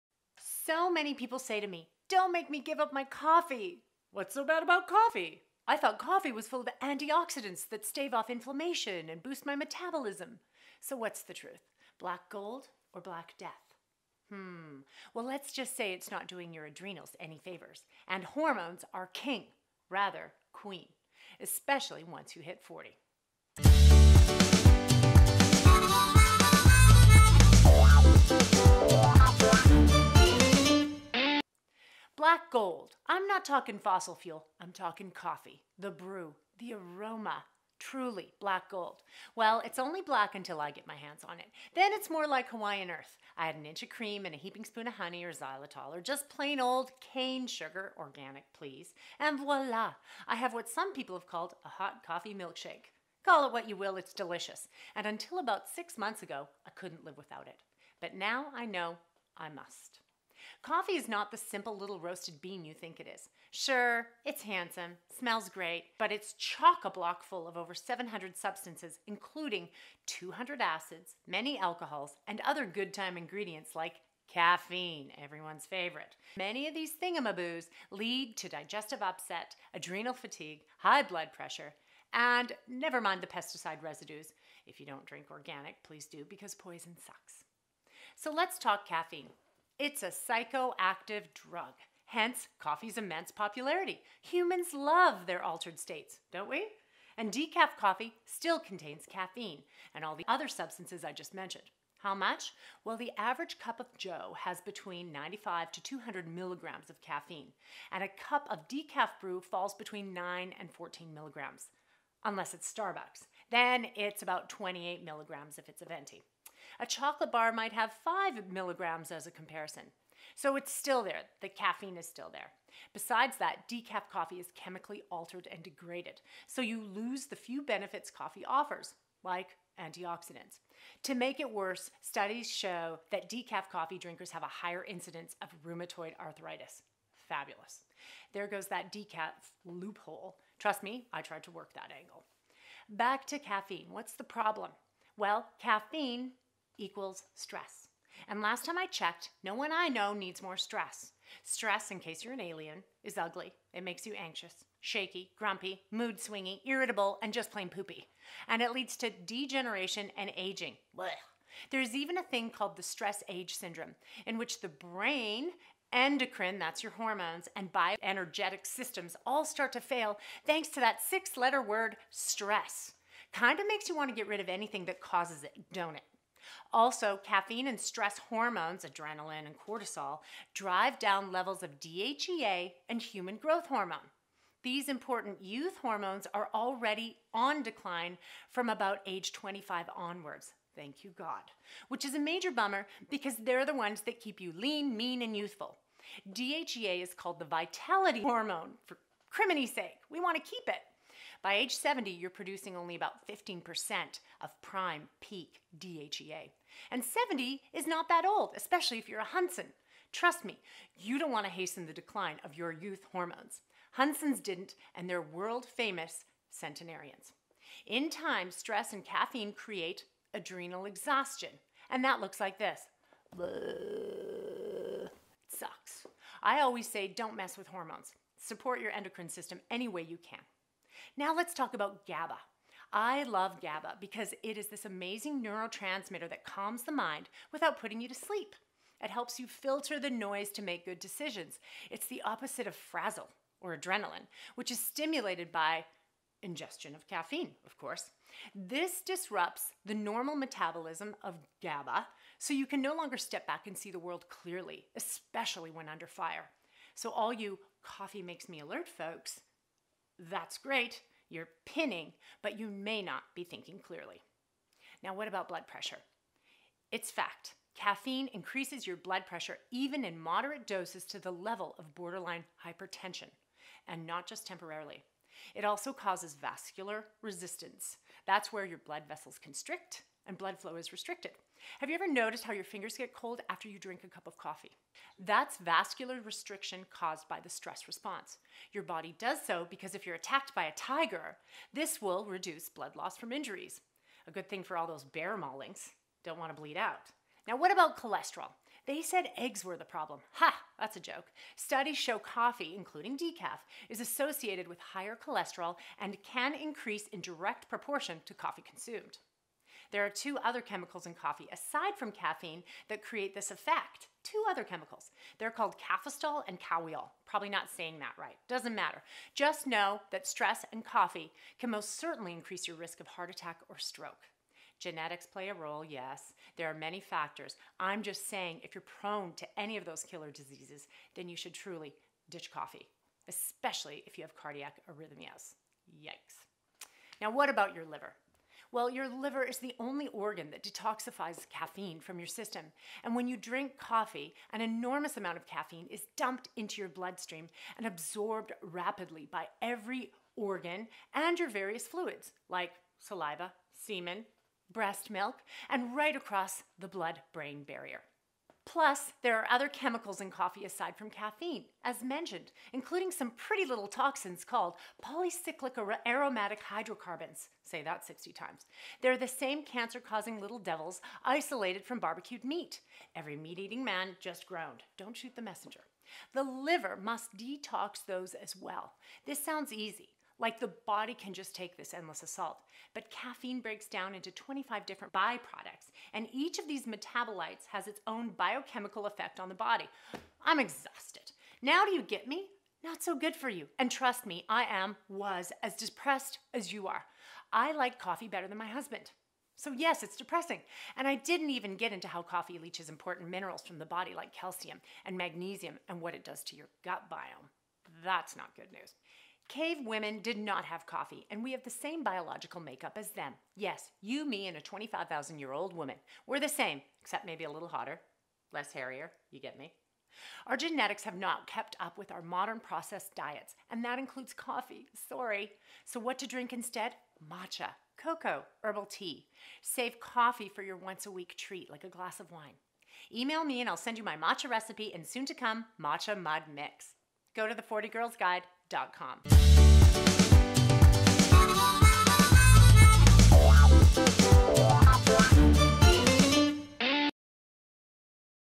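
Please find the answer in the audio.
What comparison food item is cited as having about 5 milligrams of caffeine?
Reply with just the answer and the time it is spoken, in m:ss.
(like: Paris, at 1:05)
chocolate bar, at 1:56.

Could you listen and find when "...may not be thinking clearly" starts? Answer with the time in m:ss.
4:22.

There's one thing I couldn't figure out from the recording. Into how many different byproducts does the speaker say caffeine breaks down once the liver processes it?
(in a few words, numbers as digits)
25.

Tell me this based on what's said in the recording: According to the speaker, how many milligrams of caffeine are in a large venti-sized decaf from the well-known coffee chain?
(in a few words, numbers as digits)
28 milligrams.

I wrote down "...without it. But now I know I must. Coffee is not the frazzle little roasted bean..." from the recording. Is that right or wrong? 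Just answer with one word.
wrong.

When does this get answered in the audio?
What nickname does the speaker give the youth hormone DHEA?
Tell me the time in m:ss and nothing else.
3:17.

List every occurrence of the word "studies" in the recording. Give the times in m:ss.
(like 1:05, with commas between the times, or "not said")
2:12, 5:01.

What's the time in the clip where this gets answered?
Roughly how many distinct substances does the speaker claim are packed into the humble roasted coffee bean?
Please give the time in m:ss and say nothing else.
1:07.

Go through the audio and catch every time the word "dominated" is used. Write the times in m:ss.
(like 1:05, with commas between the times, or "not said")
not said.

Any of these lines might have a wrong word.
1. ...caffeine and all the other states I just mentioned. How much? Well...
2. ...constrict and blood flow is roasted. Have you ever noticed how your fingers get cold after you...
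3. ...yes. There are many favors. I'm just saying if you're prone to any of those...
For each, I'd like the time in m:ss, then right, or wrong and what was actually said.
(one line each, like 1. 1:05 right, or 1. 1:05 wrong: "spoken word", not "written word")
1. 1:39 wrong: "substances", not "states"
2. 4:39 wrong: "restricted", not "roasted"
3. 5:25 wrong: "factors", not "favors".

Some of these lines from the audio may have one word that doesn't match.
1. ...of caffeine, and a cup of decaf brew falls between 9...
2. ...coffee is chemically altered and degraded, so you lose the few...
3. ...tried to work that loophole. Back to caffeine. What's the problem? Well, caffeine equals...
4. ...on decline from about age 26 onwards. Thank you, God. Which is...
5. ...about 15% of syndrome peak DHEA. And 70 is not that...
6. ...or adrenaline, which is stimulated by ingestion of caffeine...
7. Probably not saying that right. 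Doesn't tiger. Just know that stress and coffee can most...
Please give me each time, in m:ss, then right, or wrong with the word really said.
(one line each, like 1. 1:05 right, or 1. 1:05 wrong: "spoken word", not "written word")
1. 1:46 right
2. 2:04 right
3. 2:21 wrong: "angle", not "loophole"
4. 3:07 wrong: "25", not "26"
5. 3:22 wrong: "prime", not "syndrome"
6. 4:03 right
7. 5:17 wrong: "matter", not "tiger".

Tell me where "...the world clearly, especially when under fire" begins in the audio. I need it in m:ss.
4:13.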